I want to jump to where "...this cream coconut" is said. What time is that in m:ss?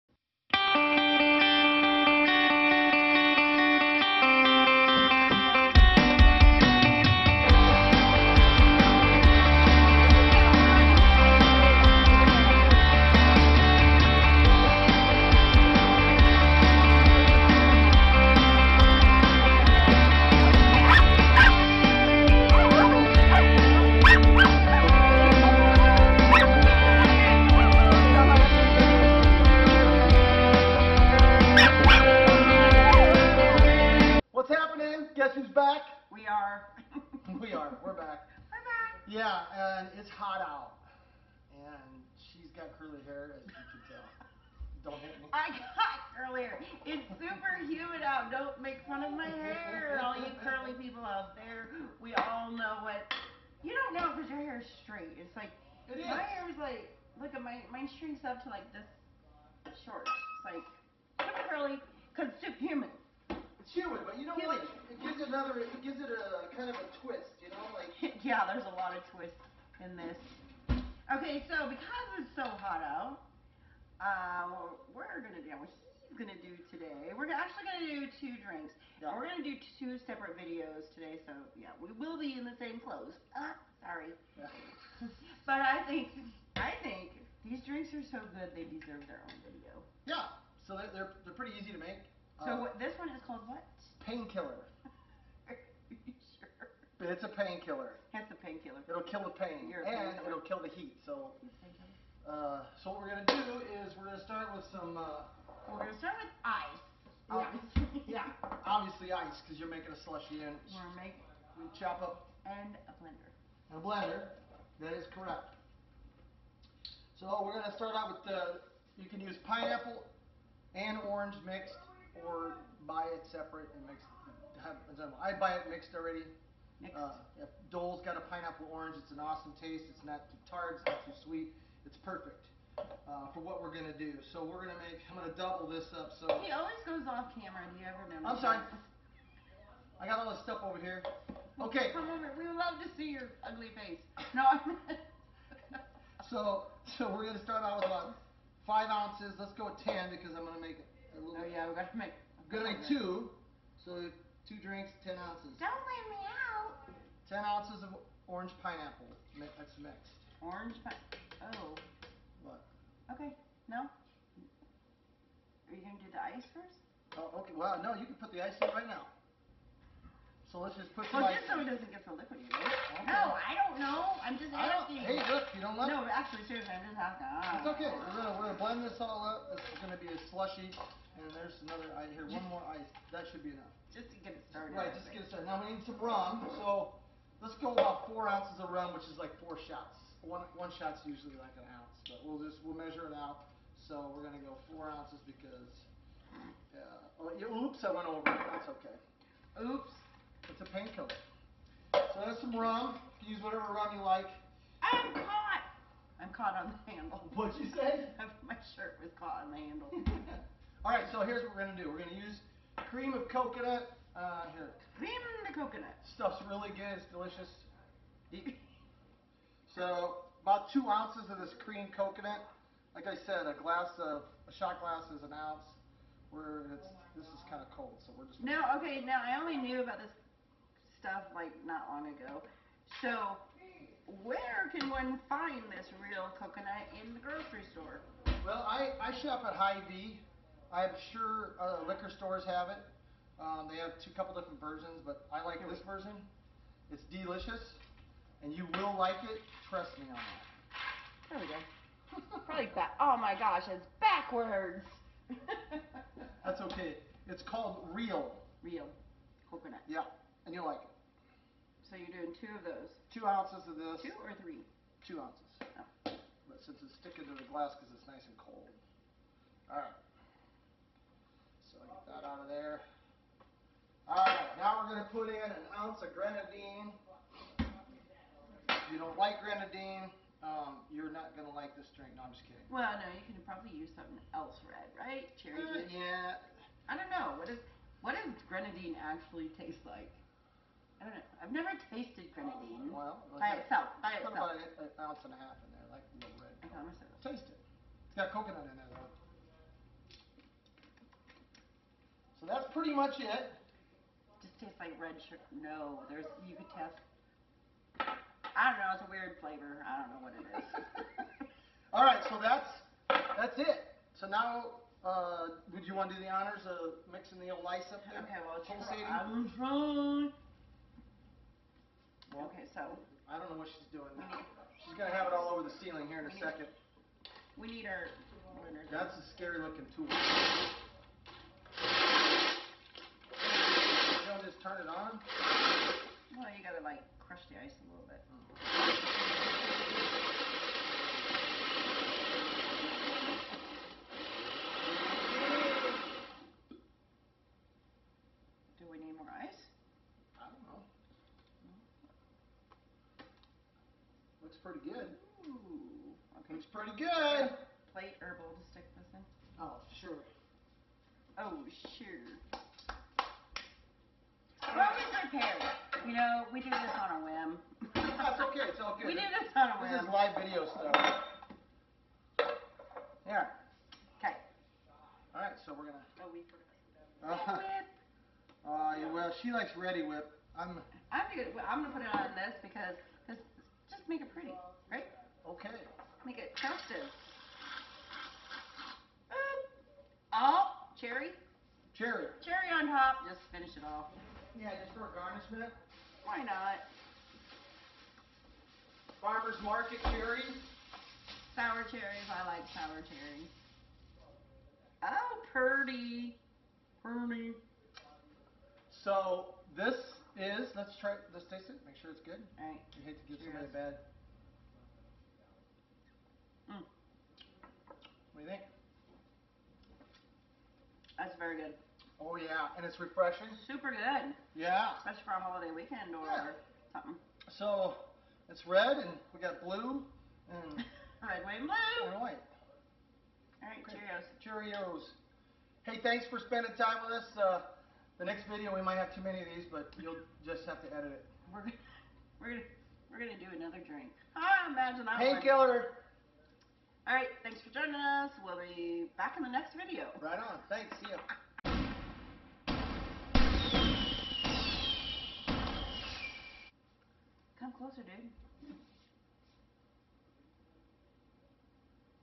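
3:41.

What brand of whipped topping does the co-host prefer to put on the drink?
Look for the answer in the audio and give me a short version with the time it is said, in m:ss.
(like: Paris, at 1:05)
Reddi-wip, at 6:19.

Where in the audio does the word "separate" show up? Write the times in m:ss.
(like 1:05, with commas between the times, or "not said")
1:20, 2:03.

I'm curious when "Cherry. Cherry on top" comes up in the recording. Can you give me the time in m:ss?
6:31.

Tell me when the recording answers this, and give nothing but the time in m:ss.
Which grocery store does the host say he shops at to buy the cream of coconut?
3:59.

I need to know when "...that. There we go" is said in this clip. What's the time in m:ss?
4:10.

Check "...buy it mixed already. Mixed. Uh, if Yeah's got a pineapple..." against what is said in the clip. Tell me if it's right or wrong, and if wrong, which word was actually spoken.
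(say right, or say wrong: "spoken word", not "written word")
wrong: "Dole", not "Yeah".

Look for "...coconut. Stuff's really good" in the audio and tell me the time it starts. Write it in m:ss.
3:35.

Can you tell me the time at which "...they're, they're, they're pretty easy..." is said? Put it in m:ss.
1:30.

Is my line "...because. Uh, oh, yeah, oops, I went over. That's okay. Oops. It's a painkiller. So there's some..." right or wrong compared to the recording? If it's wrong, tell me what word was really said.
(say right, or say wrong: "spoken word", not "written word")
right.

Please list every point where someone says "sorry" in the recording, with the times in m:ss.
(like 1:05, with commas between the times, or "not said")
1:23, 2:18.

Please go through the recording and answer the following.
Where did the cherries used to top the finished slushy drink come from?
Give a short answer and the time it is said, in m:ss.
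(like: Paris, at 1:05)
Farmer's Market, at 6:39.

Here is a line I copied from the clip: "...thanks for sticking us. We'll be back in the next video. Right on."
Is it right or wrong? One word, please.
wrong.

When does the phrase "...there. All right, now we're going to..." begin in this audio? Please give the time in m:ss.
4:32.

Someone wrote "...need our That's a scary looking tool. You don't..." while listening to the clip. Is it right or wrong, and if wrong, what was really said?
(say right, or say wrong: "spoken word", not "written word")
right.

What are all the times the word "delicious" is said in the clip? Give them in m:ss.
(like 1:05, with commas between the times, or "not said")
3:37, 4:07.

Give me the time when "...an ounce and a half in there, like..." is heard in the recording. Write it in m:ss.
4:54.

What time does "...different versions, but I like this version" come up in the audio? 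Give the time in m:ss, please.
4:04.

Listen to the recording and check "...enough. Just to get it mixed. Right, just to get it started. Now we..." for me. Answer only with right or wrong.
wrong.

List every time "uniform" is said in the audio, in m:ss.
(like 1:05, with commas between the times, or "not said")
not said.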